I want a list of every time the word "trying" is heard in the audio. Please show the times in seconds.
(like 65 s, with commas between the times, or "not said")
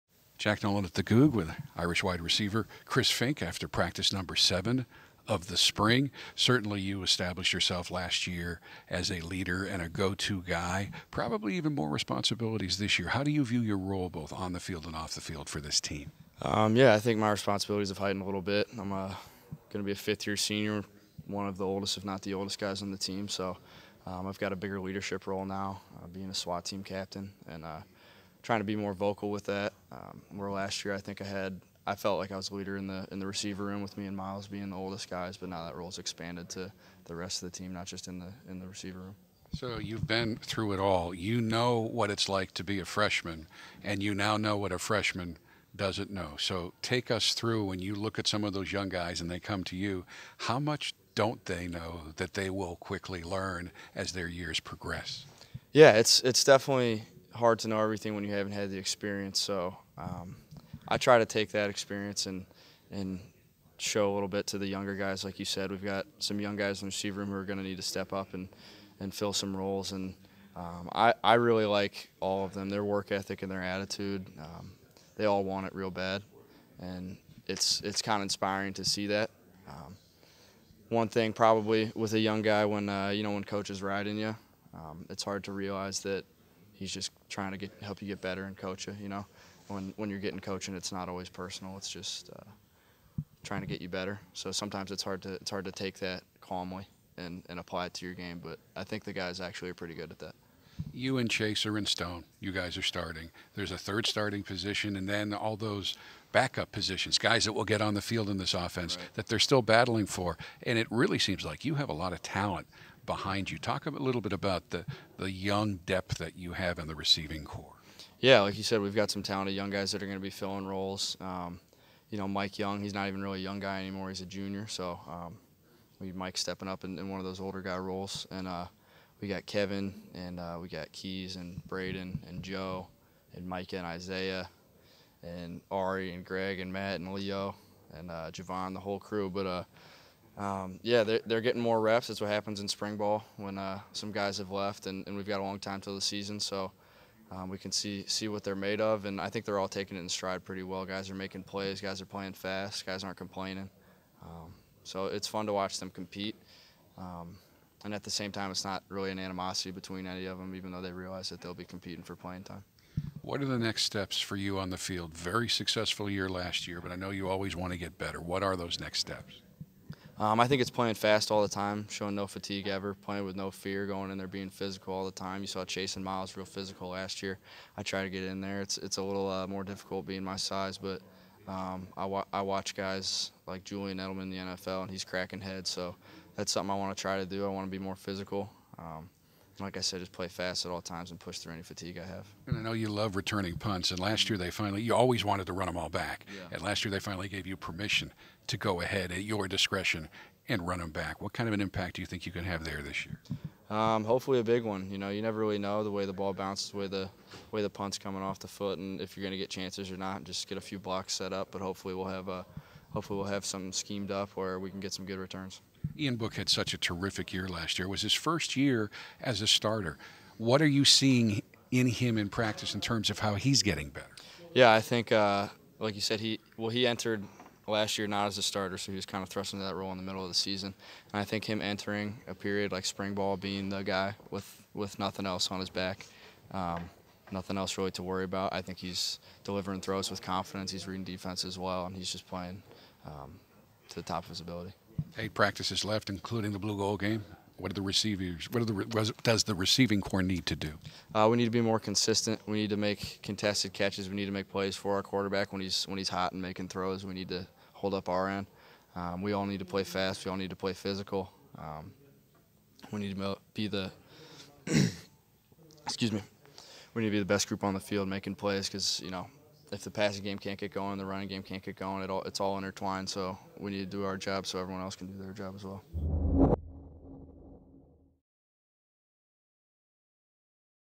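28 s, 87 s, 93 s.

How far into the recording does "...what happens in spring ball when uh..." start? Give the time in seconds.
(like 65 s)
142 s.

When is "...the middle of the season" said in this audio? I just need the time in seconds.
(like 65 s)
229 s.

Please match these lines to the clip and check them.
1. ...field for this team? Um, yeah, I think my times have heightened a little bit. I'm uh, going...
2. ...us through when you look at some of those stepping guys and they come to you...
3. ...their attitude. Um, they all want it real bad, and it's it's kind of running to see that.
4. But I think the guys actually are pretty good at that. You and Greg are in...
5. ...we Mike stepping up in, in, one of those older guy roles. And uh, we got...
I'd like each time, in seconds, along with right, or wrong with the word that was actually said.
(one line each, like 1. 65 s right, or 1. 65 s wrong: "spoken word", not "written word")
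1. 15 s wrong: "responsibilities", not "times"
2. 47 s wrong: "young", not "stepping"
3. 73 s wrong: "inspiring", not "running"
4. 98 s wrong: "Chase", not "Greg"
5. 125 s right.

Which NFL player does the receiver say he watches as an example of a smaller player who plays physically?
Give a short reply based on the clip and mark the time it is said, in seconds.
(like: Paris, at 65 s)
Julian Edelman, at 183 s.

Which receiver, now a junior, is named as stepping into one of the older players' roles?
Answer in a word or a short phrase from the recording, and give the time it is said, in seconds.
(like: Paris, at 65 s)
Mike Young, at 122 s.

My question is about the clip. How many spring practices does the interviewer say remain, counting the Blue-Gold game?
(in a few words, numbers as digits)
8.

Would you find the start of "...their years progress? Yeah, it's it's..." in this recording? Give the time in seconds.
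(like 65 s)
54 s.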